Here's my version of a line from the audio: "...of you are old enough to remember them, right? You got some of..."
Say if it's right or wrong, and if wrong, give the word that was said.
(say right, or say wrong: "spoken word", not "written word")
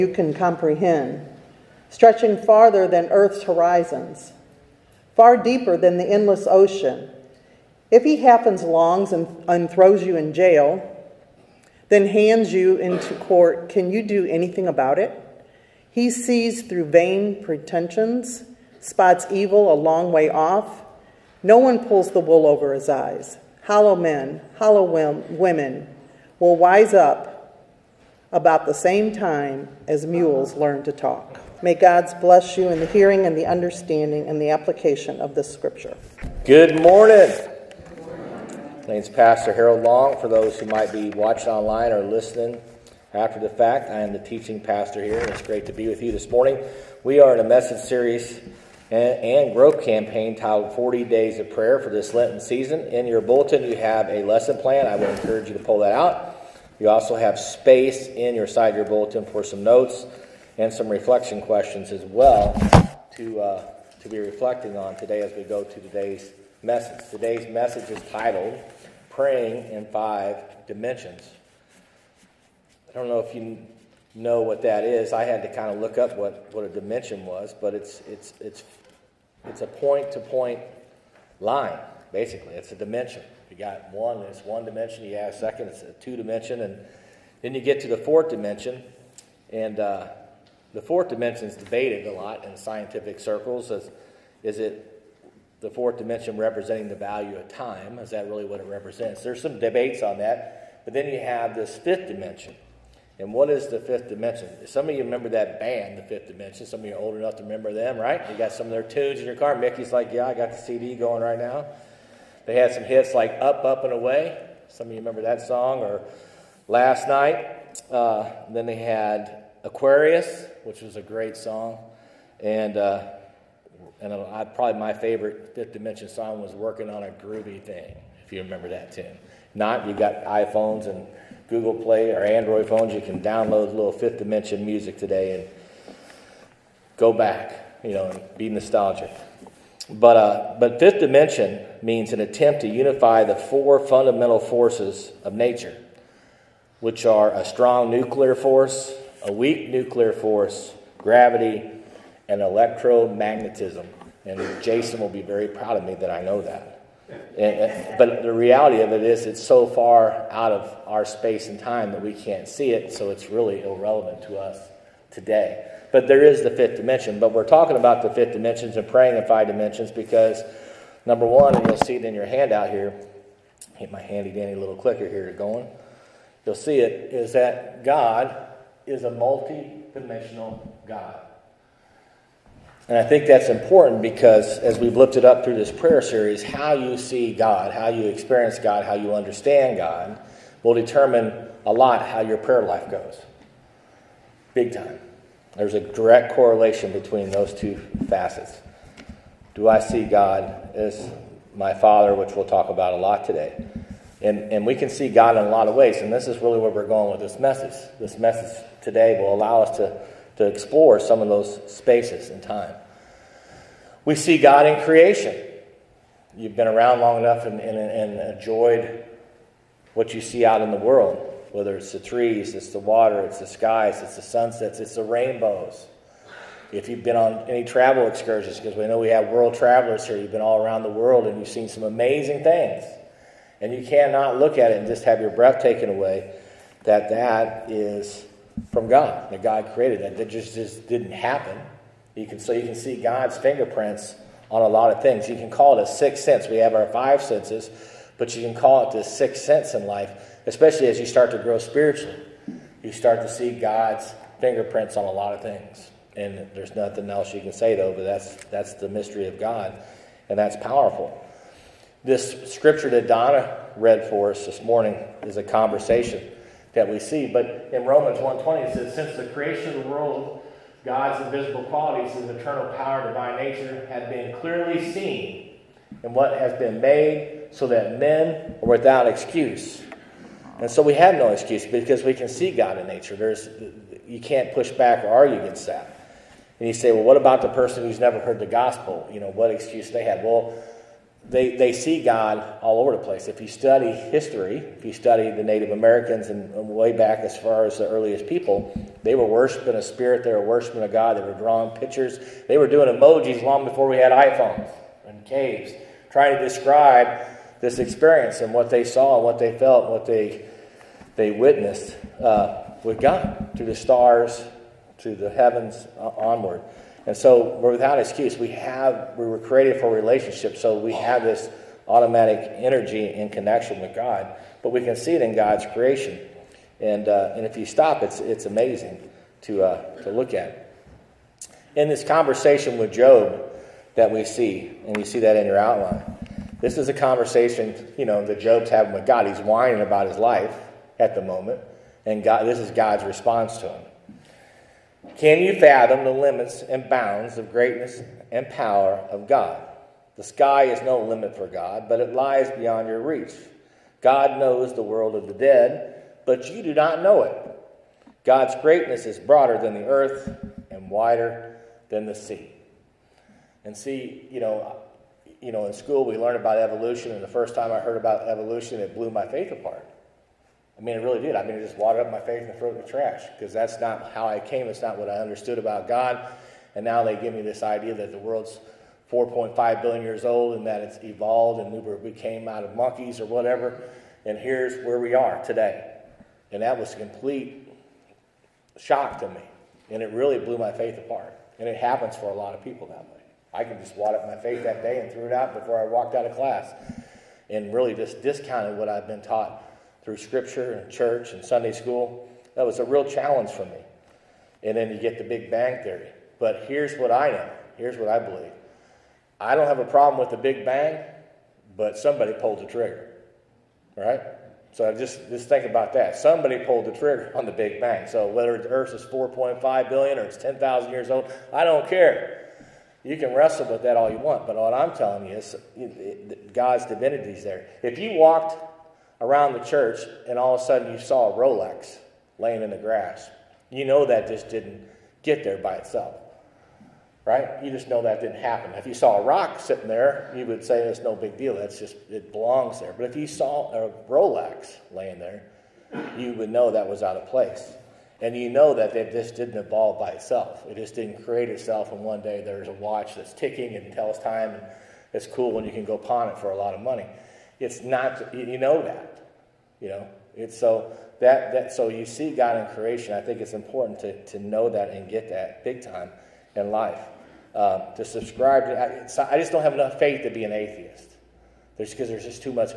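right.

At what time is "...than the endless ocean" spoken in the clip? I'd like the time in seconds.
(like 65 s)
5 s.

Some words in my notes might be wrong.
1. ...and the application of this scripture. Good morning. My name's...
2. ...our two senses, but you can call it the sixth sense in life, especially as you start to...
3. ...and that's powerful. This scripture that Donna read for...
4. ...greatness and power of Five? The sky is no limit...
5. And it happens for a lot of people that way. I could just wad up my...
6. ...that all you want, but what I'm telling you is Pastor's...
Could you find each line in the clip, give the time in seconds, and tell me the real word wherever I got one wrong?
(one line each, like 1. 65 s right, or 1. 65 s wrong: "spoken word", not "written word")
1. 34 s right
2. 246 s wrong: "five", not "two"
3. 260 s right
4. 347 s wrong: "God", not "Five"
5. 391 s right
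6. 423 s wrong: "God", not "Pastor".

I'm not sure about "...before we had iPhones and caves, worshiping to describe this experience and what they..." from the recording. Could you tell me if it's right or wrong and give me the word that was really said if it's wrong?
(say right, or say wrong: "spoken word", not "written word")
wrong: "trying", not "worshiping".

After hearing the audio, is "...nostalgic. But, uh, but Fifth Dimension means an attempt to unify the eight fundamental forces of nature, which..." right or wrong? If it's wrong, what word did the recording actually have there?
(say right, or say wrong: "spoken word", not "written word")
wrong: "four", not "eight".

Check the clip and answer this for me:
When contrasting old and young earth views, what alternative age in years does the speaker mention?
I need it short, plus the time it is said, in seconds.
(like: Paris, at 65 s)
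10,000, at 420 s.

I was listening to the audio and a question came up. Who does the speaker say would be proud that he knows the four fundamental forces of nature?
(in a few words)
Jason.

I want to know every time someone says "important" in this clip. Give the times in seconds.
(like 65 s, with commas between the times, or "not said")
183 s, 463 s.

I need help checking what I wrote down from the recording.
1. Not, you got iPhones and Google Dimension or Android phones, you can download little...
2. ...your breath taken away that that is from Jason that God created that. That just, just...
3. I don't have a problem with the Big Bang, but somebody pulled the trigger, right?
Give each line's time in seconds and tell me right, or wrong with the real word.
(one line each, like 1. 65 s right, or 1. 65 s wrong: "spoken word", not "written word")
1. 129 s wrong: "Play", not "Dimension"
2. 235 s wrong: "God", not "Jason"
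3. 409 s right.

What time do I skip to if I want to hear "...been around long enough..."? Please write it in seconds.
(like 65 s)
216 s.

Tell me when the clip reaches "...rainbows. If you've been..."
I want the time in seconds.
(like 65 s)
225 s.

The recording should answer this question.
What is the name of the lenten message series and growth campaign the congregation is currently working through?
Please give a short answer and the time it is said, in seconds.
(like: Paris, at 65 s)
40 Days of Prayer, at 50 s.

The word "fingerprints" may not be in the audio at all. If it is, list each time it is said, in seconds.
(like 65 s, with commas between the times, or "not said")
243 s, 254 s.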